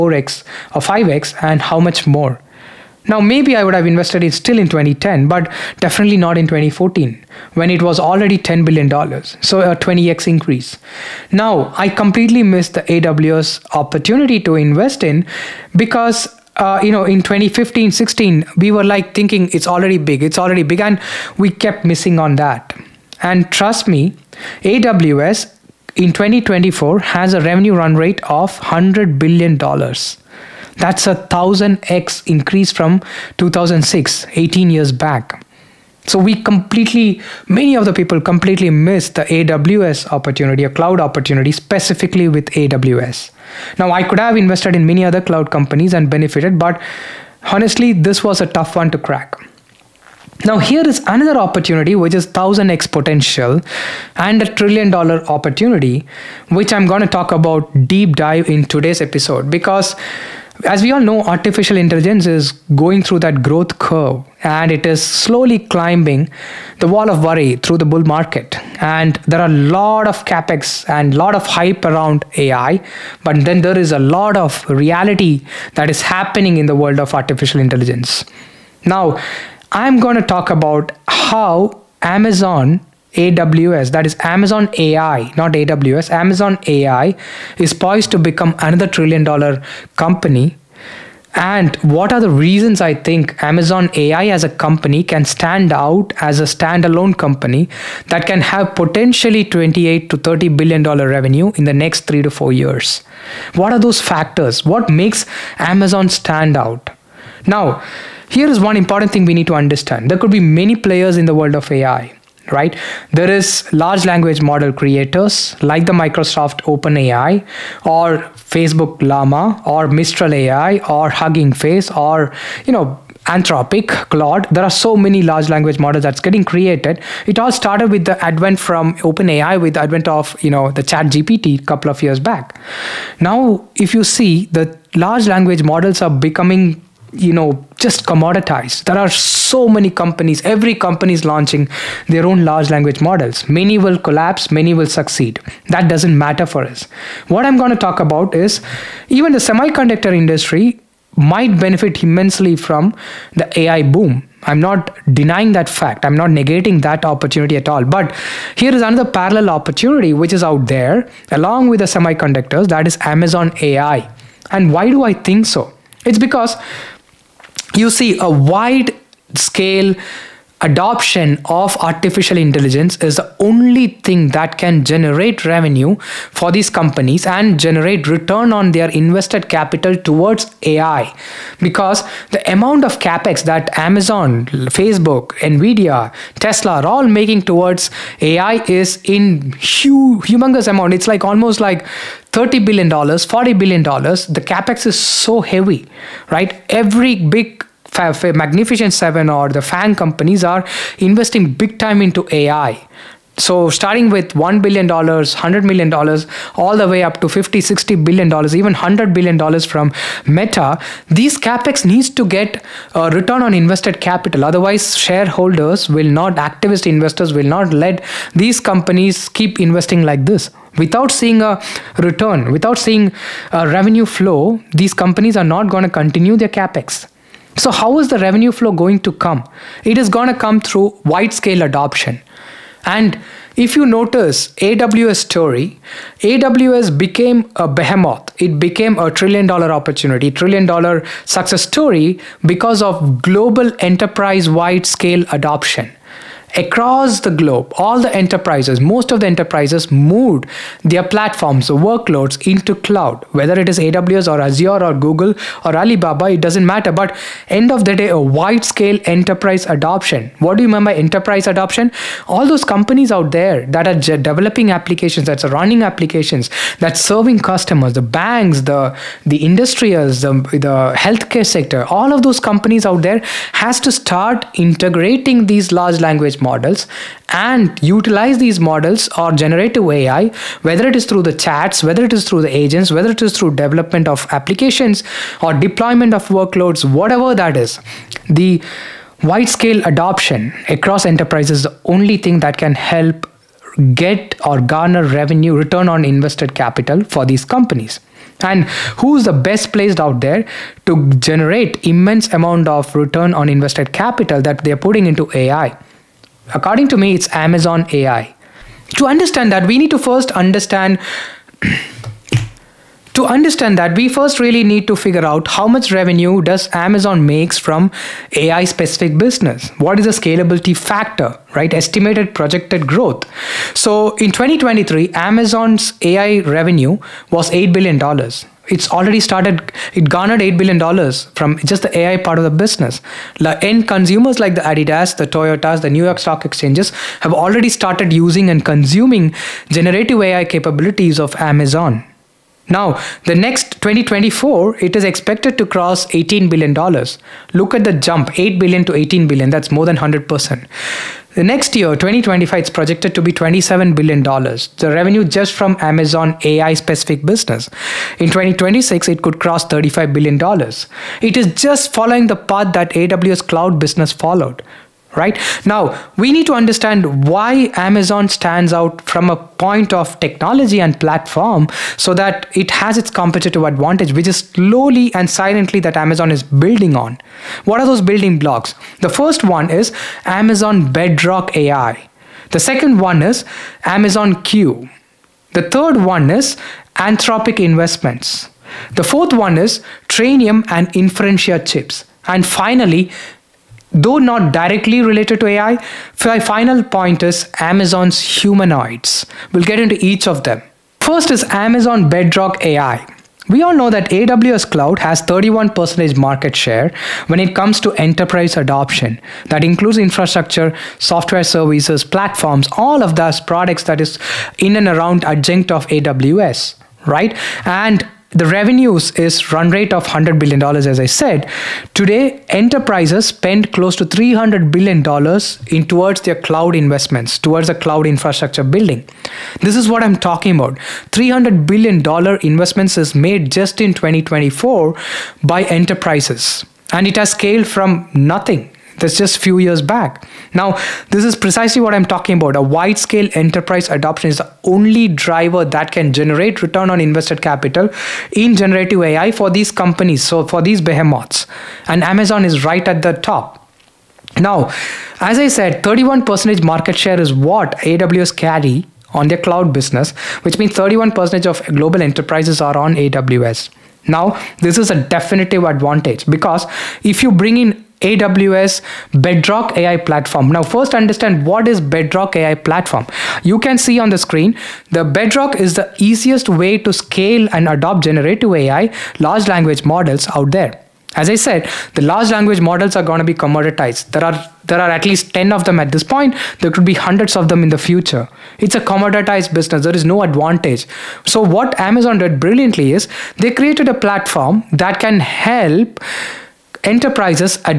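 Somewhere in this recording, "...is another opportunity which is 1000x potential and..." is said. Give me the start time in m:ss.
0:50.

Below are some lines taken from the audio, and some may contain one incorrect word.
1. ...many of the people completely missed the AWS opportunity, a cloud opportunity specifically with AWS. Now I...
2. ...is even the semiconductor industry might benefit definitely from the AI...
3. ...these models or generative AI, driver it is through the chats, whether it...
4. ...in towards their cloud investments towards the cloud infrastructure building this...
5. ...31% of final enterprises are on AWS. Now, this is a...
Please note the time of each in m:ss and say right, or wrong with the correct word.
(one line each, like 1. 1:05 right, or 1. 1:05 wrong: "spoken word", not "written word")
1. 0:37 right
2. 2:28 wrong: "immensely", not "definitely"
3. 4:38 wrong: "whether", not "driver"
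4. 7:05 right
5. 7:40 wrong: "global", not "final".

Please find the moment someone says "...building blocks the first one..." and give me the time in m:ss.
6:18.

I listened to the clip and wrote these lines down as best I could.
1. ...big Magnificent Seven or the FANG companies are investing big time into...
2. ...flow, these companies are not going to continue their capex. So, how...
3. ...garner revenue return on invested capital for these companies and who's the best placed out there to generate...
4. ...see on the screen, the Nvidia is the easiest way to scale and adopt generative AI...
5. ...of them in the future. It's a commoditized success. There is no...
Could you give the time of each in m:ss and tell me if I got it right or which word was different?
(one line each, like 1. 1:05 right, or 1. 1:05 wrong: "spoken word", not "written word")
1. 3:17 right
2. 3:44 right
3. 4:54 right
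4. 7:53 wrong: "Bedrock", not "Nvidia"
5. 8:07 wrong: "business", not "success".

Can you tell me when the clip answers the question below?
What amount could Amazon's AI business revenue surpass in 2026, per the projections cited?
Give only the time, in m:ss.
5:59.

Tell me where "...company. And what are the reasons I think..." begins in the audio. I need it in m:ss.
1:29.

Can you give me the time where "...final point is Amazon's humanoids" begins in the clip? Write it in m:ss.
6:36.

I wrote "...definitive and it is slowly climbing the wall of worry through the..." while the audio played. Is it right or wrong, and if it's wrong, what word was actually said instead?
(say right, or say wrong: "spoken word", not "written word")
wrong: "curve", not "definitive".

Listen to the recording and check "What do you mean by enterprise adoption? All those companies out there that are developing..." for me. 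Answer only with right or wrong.
right.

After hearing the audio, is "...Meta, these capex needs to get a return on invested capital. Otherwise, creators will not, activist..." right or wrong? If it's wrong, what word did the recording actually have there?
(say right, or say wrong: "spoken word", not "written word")
wrong: "shareholders", not "creators".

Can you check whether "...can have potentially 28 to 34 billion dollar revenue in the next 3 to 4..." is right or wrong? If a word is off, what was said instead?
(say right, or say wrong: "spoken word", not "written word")
wrong: "30", not "34".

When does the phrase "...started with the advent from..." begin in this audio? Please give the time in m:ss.
2:07.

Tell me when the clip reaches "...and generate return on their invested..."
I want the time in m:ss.
2:57.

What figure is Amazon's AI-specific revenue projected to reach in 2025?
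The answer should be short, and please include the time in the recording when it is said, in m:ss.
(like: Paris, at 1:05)
$27 billion, at 5:53.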